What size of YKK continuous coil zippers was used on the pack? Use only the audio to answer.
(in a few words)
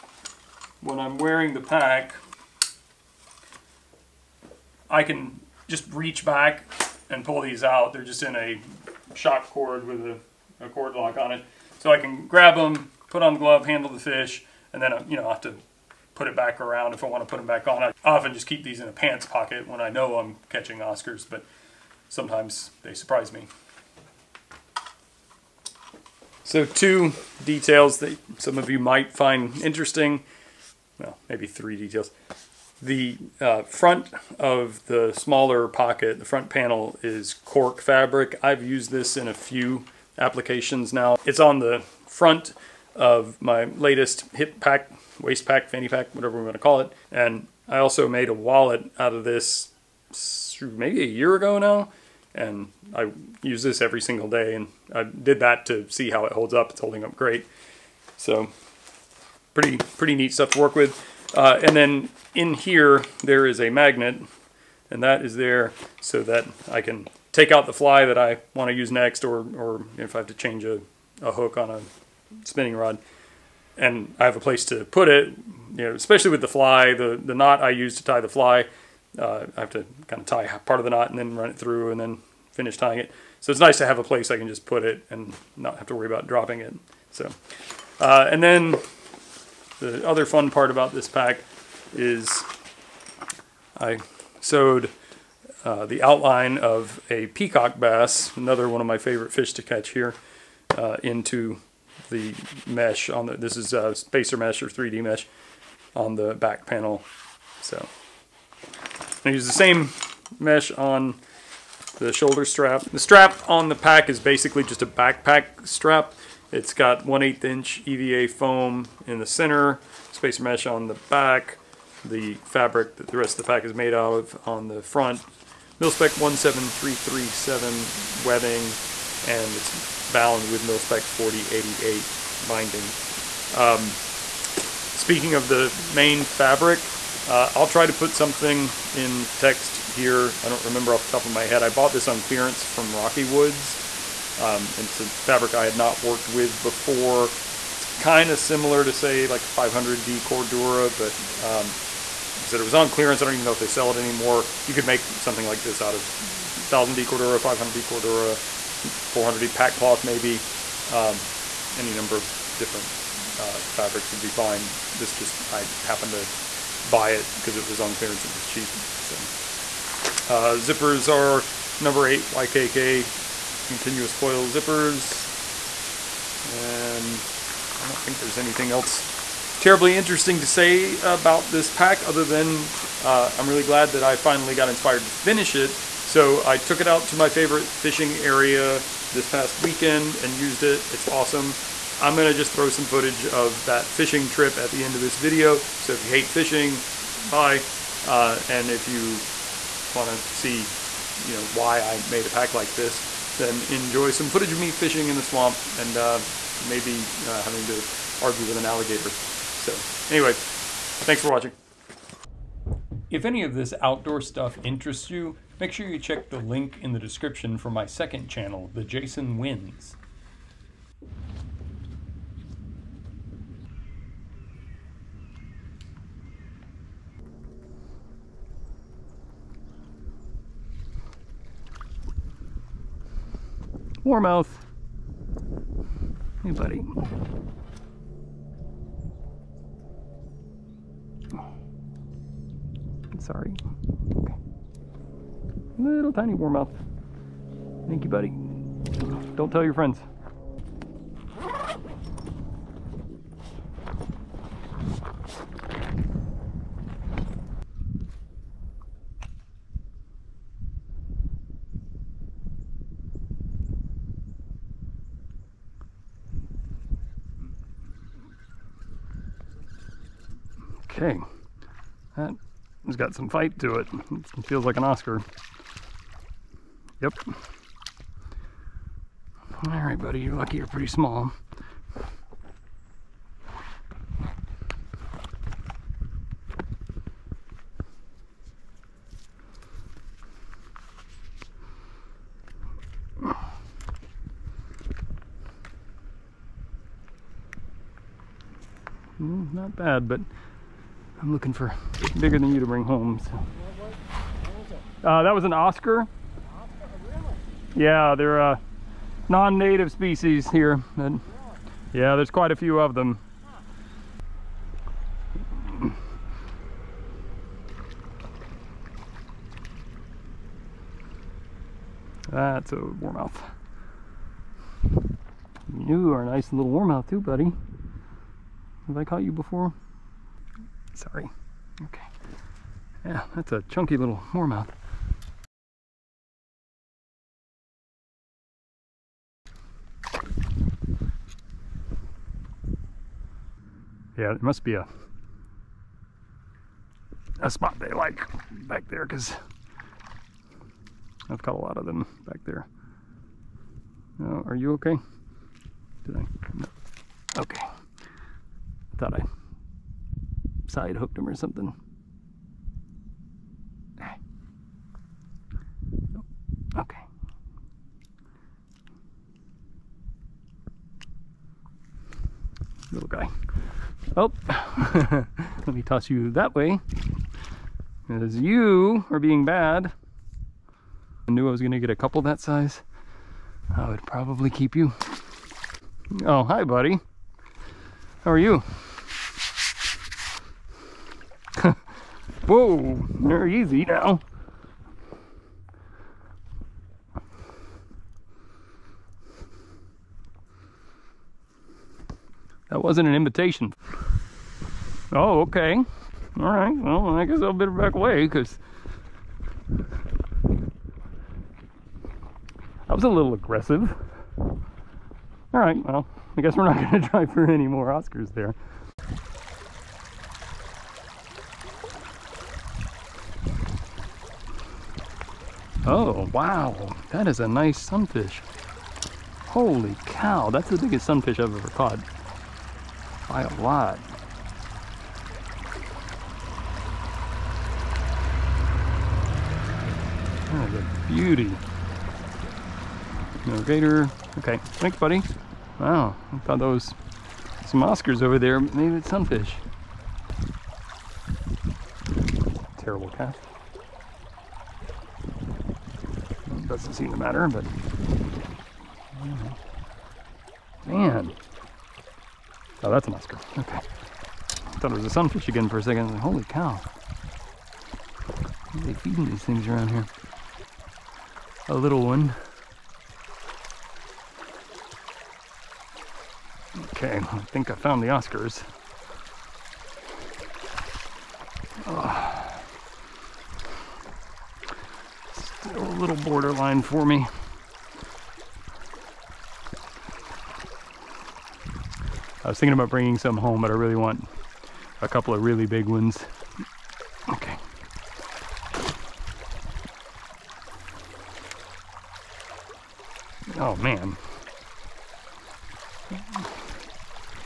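number 8.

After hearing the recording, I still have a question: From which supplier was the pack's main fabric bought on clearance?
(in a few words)
Rocky Woods.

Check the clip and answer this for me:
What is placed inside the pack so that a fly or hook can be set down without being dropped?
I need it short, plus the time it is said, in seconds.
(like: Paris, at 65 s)
magnet, at 63 s.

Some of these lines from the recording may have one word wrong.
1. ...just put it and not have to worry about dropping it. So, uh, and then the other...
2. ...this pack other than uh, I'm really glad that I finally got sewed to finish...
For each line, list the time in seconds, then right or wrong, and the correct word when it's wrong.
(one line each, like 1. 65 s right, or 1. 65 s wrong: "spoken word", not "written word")
1. 84 s right
2. 181 s wrong: "inspired", not "sewed".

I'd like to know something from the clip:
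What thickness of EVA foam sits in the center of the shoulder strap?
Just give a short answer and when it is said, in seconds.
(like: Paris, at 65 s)
1/8 inch, at 117 s.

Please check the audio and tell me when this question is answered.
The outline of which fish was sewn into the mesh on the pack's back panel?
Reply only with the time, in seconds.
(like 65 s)
97 s.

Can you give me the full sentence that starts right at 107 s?
So I use the same mesh on the shoulder strap.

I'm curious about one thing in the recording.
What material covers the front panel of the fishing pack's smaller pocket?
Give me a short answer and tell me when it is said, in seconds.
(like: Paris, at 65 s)
cork fabric, at 37 s.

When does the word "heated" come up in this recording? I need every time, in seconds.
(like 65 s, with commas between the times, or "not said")
not said.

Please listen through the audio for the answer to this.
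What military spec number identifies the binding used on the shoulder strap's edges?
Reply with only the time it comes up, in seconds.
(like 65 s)
130 s.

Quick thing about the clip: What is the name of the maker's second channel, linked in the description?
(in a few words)
The Jason Wins.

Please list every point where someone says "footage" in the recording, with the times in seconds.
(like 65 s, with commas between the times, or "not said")
192 s, 204 s.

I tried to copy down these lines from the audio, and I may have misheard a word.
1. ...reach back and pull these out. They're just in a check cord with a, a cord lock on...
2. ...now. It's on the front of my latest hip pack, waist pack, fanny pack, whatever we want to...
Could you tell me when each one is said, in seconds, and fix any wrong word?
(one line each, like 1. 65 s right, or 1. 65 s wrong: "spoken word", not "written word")
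1. 5 s wrong: "shock", not "check"
2. 40 s right.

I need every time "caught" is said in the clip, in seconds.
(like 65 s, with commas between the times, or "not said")
329 s, 351 s, 431 s.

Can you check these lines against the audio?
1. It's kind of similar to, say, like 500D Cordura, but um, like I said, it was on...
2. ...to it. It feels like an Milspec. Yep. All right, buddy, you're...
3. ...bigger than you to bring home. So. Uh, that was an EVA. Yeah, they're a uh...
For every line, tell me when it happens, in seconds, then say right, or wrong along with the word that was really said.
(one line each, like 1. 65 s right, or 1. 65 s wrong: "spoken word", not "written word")
1. 147 s right
2. 273 s wrong: "Oscar", not "Milspec"
3. 302 s wrong: "Oscar", not "EVA".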